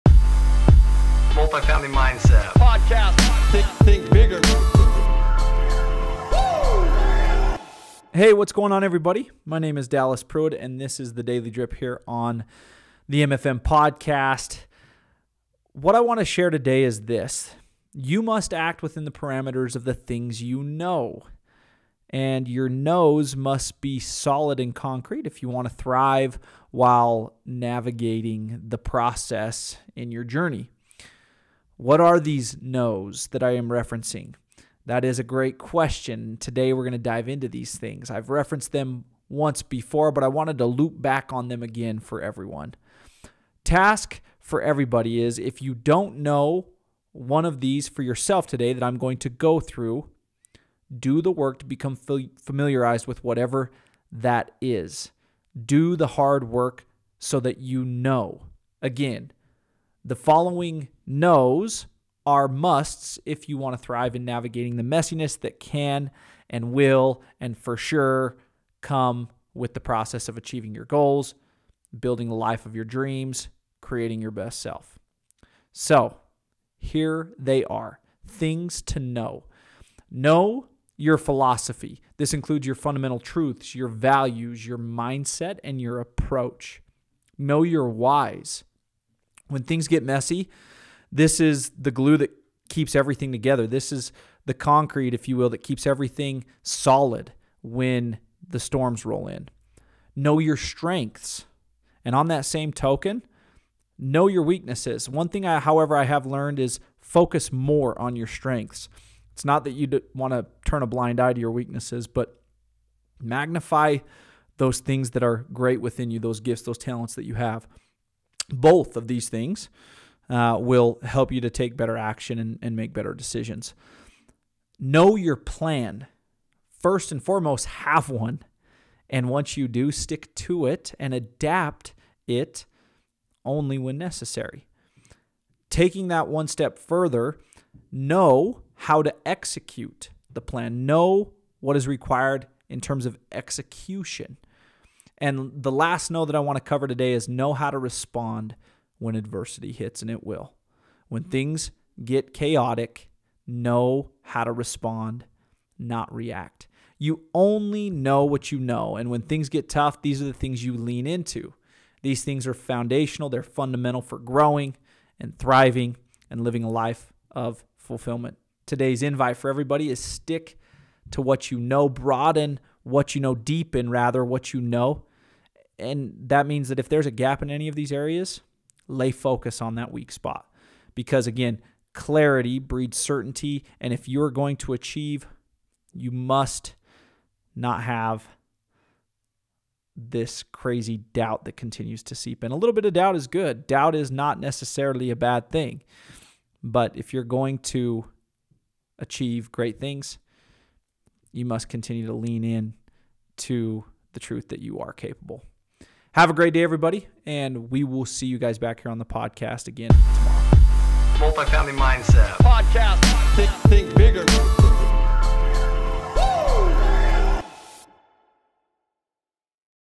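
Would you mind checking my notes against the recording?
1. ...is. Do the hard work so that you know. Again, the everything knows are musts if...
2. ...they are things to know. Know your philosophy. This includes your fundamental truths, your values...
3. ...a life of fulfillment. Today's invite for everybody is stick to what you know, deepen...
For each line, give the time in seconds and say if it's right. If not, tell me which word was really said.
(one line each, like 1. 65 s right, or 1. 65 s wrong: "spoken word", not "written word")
1. 54 s wrong: "following", not "everything"
2. 77 s right
3. 166 s wrong: "broaden", not "deepen".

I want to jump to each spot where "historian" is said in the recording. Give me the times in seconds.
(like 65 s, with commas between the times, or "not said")
not said.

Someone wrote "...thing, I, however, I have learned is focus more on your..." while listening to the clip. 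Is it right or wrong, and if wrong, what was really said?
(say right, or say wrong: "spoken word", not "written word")
right.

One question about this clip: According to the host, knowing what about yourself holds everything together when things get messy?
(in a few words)
Your whys.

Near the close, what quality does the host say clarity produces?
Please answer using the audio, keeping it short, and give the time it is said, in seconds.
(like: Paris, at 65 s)
Certainty, at 182 s.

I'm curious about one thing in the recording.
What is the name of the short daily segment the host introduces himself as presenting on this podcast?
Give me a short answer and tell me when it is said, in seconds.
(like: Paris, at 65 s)
Daily Drip, at 11 s.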